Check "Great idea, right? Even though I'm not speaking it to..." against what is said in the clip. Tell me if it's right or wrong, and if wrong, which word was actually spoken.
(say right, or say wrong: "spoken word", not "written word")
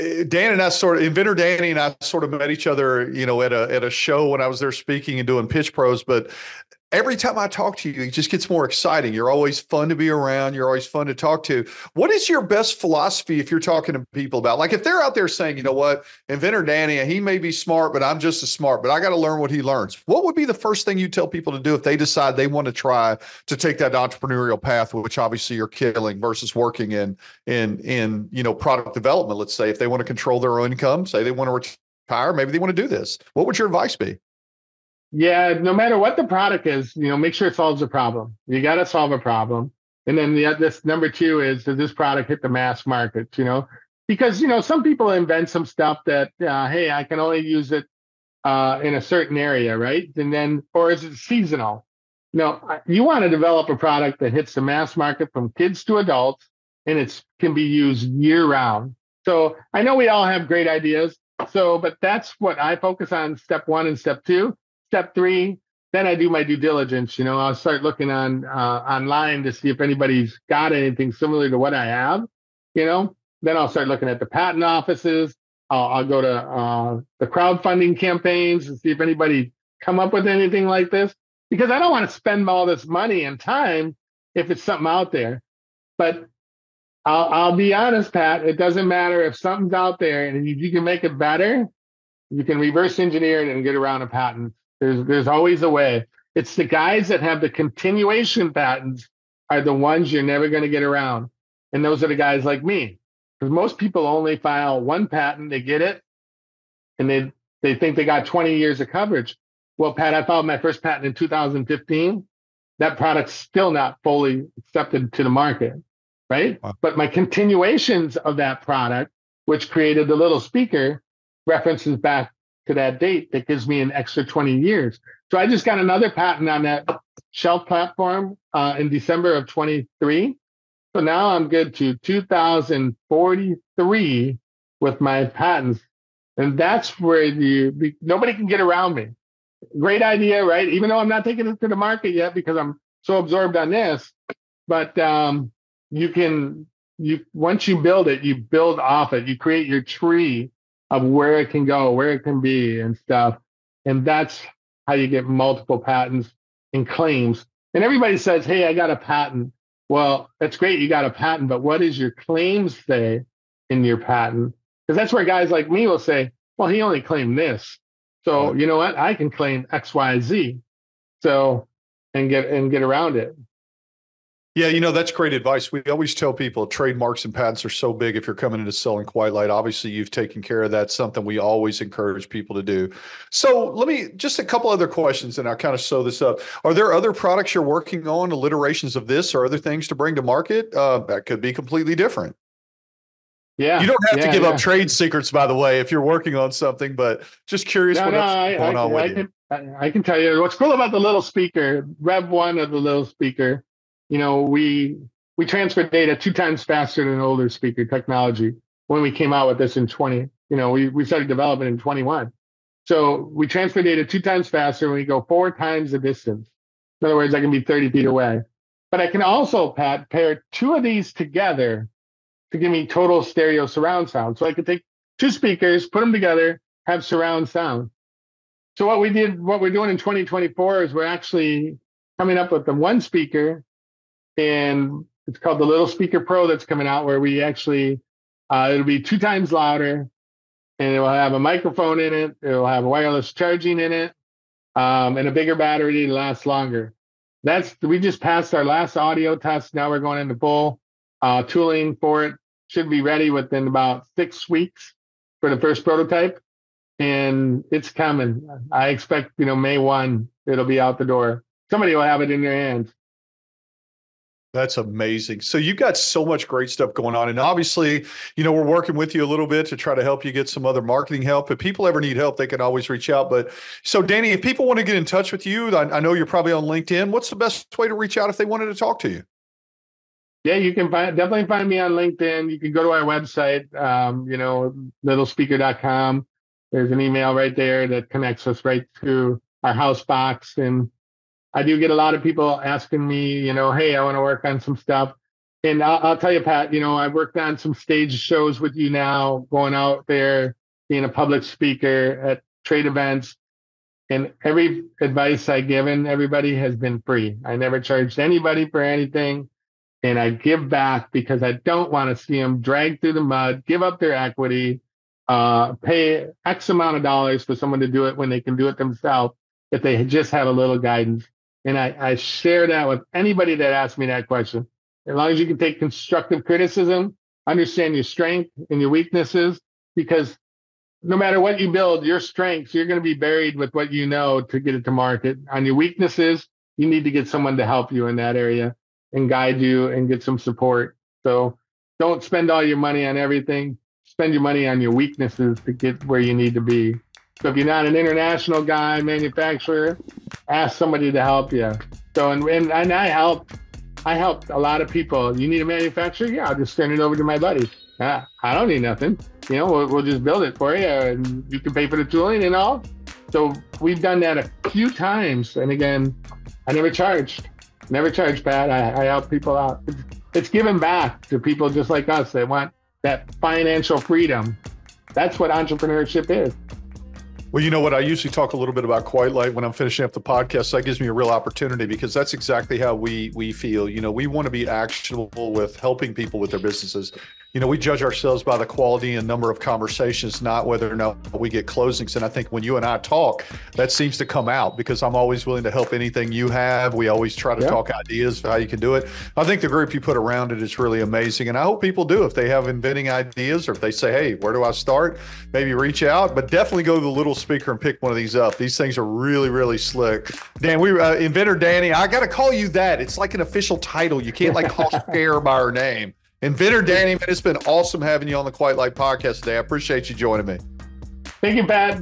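wrong: "taking", not "speaking".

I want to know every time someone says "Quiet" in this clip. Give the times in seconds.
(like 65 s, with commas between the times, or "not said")
179 s, 379 s, 418 s.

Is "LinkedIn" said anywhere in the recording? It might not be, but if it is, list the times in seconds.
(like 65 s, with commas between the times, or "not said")
276 s, 281 s.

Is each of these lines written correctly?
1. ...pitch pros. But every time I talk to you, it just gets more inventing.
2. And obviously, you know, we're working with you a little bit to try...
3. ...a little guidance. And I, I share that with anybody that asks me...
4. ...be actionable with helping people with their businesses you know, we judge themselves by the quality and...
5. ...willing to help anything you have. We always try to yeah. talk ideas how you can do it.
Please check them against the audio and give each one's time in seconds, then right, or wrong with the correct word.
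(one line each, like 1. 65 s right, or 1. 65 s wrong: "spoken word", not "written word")
1. 5 s wrong: "exciting", not "inventing"
2. 267 s right
3. 320 s right
4. 384 s wrong: "ourselves", not "themselves"
5. 395 s right.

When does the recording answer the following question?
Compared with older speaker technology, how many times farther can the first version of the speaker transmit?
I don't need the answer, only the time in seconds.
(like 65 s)
215 s.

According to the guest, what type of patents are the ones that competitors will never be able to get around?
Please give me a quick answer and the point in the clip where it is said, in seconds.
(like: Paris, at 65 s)
continuation patents, at 97 s.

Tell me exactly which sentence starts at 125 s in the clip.
So I just got another patent on that shelf platform uh, in December of 23.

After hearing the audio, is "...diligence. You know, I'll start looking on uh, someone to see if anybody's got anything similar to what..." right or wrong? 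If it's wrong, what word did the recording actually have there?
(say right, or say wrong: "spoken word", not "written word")
wrong: "online", not "someone".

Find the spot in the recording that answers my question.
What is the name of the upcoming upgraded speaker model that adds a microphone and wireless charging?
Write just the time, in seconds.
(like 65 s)
235 s.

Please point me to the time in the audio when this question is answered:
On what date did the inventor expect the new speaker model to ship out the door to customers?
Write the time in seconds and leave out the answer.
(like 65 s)
259 s.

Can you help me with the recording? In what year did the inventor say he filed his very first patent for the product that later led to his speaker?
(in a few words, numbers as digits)
2015.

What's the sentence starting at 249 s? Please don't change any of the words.
Now we're going into full uh, tooling for it.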